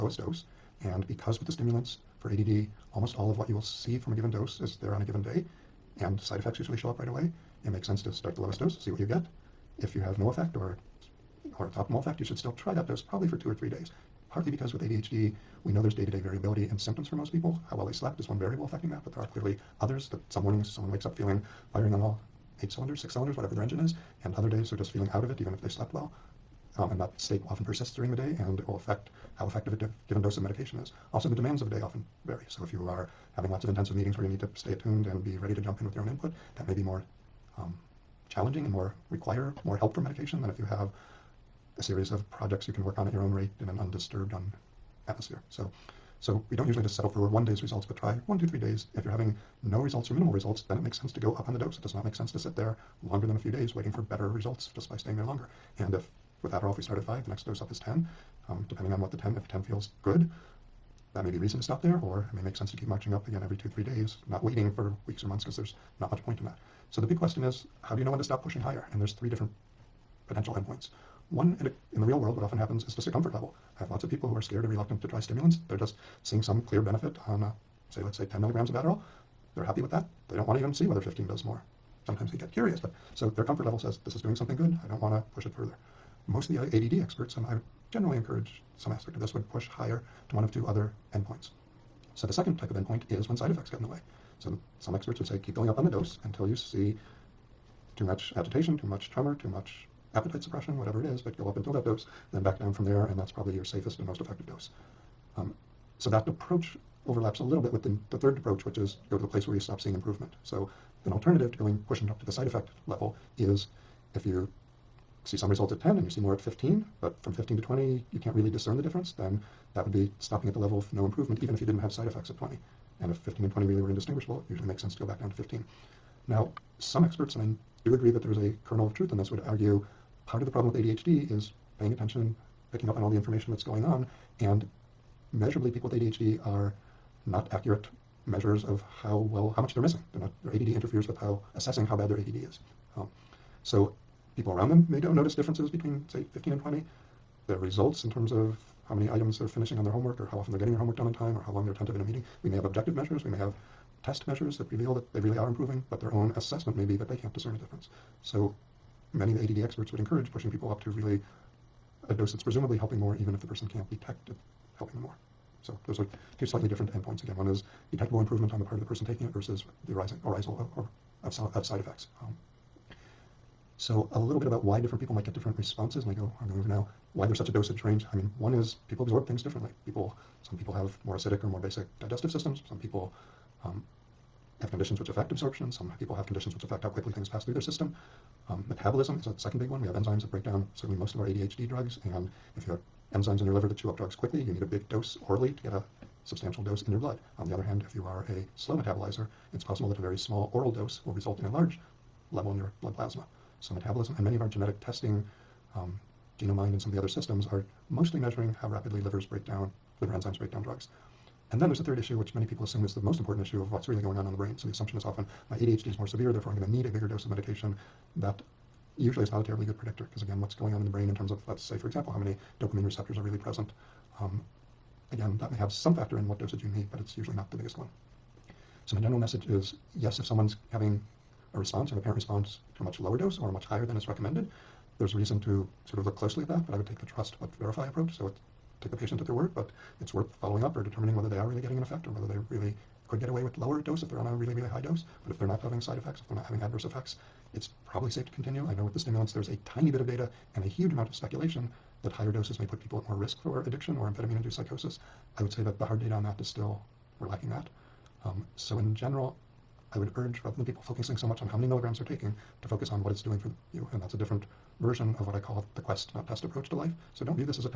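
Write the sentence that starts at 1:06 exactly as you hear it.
So the big question is, how do you know when to stop pushing higher?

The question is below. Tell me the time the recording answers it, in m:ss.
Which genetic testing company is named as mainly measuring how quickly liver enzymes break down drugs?
3:26.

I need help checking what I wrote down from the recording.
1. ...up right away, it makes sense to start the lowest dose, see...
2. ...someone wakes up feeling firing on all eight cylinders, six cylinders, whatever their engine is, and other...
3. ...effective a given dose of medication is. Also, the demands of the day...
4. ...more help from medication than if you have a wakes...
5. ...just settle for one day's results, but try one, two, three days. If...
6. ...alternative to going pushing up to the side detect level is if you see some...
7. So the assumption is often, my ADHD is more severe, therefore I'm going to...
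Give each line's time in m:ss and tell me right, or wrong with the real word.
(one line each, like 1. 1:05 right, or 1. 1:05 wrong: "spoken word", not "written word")
1. 0:06 right
2. 0:20 right
3. 0:29 right
4. 0:39 wrong: "series", not "wakes"
5. 0:46 right
6. 1:51 wrong: "effect", not "detect"
7. 3:34 right.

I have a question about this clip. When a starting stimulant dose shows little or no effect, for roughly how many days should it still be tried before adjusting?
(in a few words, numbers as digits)
2 or 3 days.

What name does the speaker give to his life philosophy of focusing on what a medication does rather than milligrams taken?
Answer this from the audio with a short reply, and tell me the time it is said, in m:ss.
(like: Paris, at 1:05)
quest, not test, at 4:25.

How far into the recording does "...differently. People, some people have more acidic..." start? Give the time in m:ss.
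2:59.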